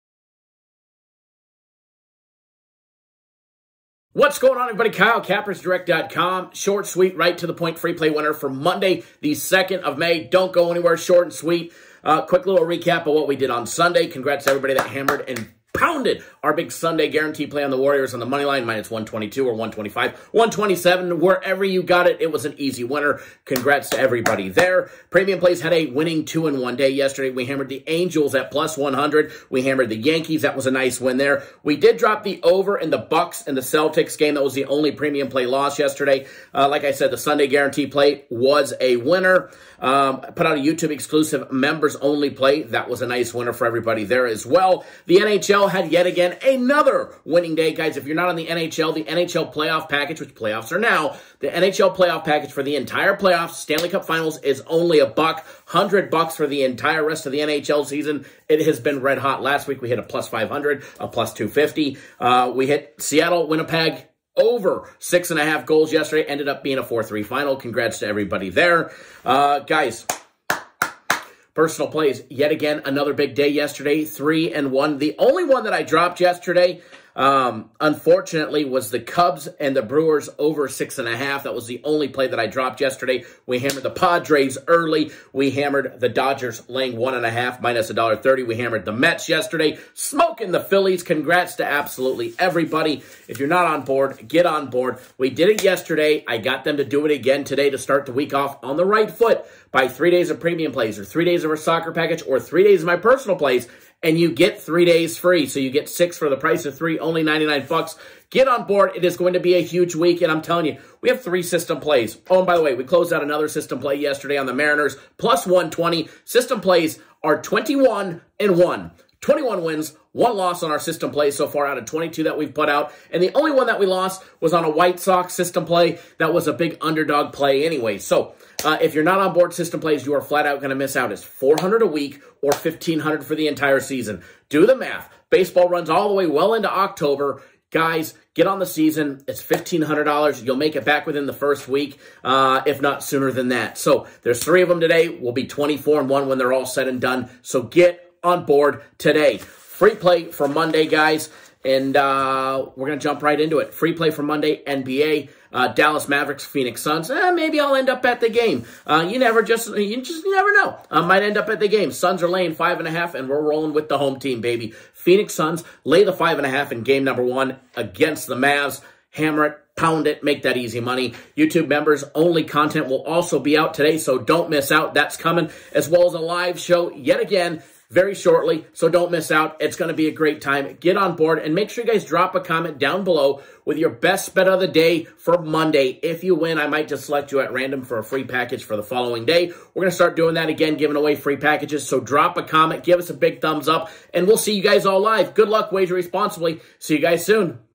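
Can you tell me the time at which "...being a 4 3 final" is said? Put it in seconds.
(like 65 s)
66 s.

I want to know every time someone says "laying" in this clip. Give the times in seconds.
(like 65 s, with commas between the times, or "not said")
86 s, 162 s.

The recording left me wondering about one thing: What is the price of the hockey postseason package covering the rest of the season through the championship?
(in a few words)
$100.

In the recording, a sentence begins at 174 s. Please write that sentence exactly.
That's coming, as well as a live show yet again very shortly, so don't miss out.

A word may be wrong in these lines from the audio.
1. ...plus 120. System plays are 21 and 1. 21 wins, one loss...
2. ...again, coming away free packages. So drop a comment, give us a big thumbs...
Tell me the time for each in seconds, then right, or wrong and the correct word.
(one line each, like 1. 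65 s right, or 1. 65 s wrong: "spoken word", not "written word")
1. 115 s right
2. 190 s wrong: "giving", not "coming".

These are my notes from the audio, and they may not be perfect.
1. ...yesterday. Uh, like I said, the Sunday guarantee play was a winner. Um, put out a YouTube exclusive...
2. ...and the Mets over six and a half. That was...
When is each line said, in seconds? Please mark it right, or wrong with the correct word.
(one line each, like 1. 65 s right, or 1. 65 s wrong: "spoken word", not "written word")
1. 35 s right
2. 79 s wrong: "Brewers", not "Mets".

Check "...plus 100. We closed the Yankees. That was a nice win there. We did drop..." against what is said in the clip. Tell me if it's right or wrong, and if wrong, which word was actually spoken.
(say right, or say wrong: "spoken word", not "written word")
wrong: "hammered", not "closed".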